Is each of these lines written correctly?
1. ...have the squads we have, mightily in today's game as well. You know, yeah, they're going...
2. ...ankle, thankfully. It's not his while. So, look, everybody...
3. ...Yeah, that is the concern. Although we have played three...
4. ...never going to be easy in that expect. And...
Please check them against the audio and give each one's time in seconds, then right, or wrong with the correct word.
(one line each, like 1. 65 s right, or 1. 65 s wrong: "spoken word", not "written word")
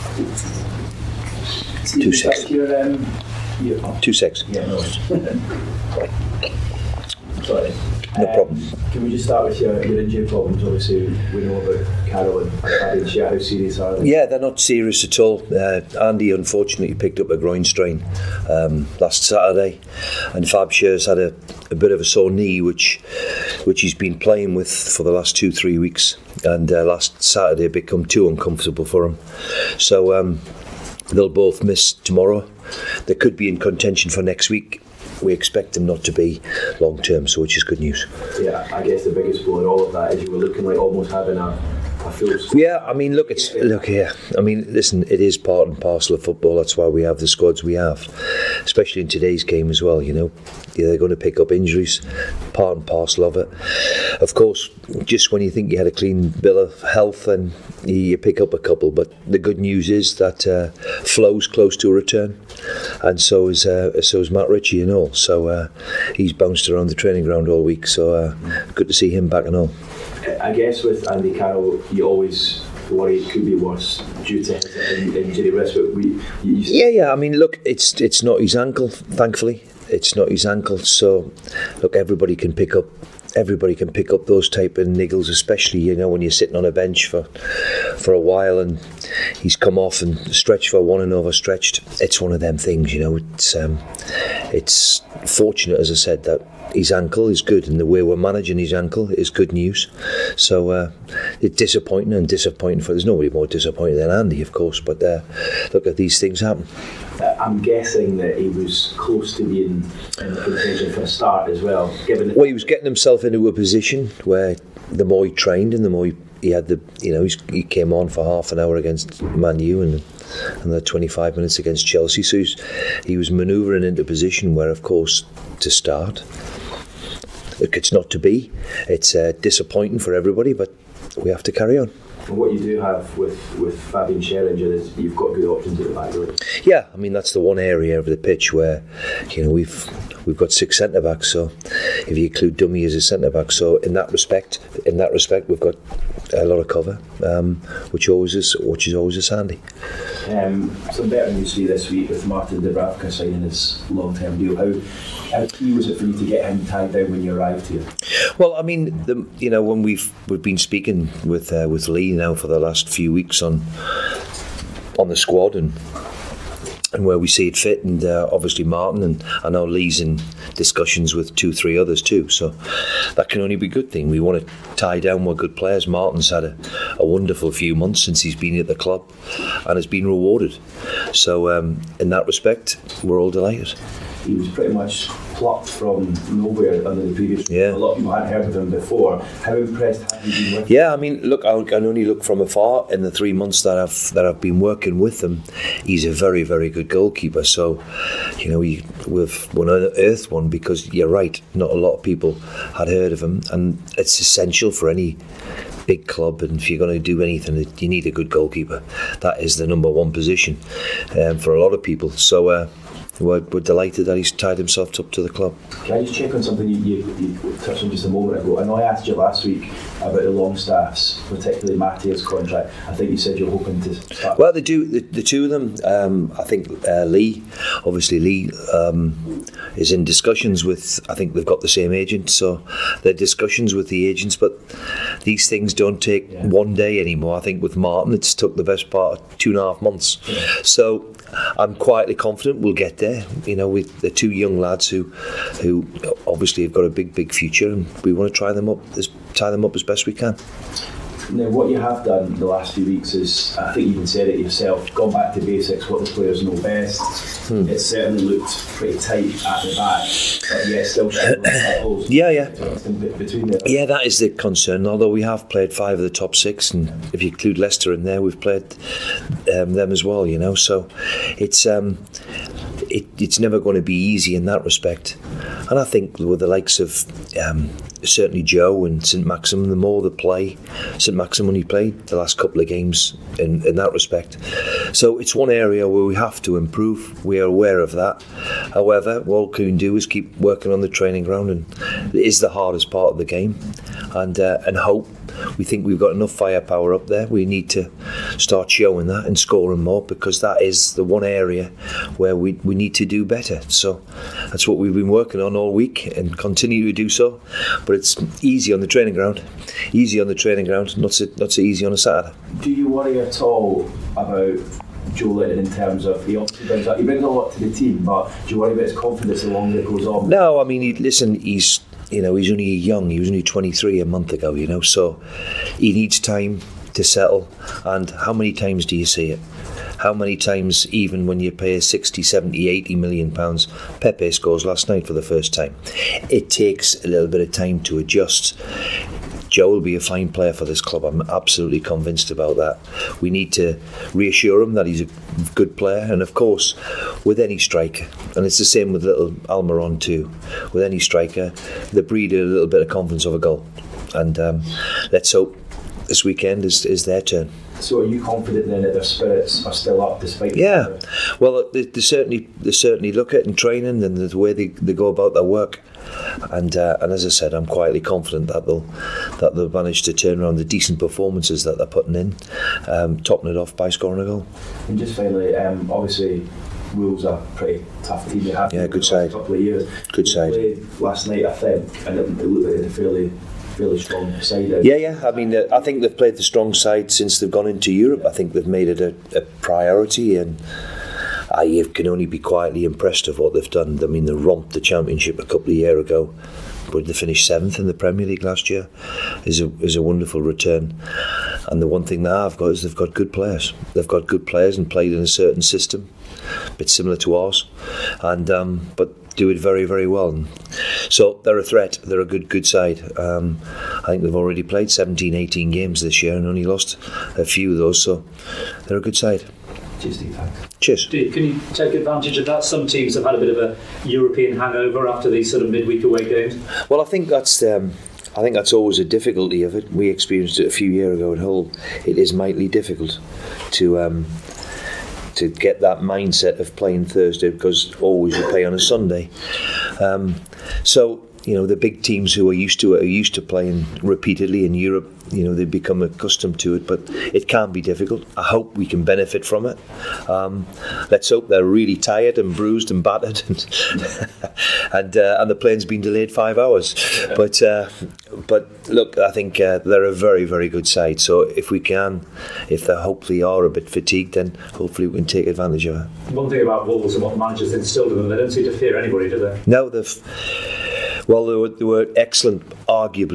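1. 47 s wrong: "especially", not "mightily"
2. 78 s wrong: "ankle", not "while"
3. 263 s wrong: "five", not "three"
4. 273 s wrong: "respect", not "expect".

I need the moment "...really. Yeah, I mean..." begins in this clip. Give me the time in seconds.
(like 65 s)
136 s.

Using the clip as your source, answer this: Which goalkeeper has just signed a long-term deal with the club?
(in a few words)
Martin Dubravka.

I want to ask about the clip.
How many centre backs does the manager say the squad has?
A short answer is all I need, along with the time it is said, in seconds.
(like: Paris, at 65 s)
6, at 140 s.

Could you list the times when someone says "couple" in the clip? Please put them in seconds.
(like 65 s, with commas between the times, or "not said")
58 s, 282 s, 379 s, 395 s.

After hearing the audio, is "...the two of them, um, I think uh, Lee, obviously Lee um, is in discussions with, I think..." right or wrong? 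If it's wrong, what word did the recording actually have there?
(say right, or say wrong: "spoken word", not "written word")
right.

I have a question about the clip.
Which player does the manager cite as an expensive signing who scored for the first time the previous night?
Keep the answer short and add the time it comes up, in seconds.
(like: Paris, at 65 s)
Pepe, at 334 s.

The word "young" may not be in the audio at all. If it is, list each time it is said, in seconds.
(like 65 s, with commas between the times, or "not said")
244 s, 322 s.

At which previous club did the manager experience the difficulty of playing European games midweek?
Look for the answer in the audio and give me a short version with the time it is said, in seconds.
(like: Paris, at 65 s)
Hull, at 431 s.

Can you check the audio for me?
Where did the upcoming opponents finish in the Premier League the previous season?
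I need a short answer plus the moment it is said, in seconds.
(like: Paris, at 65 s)
seventh, at 397 s.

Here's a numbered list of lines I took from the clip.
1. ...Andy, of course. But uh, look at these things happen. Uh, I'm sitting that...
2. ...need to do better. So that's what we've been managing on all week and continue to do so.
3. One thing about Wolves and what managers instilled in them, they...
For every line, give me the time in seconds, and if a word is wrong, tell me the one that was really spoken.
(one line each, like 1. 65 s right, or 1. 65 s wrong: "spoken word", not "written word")
1. 104 s wrong: "guessing", not "sitting"
2. 302 s wrong: "working", not "managing"
3. 466 s right.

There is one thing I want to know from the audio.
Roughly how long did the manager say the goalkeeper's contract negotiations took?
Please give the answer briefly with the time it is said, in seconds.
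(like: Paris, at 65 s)
two and a half months, at 239 s.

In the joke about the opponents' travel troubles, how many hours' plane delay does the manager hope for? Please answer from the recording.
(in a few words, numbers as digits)
5 hours.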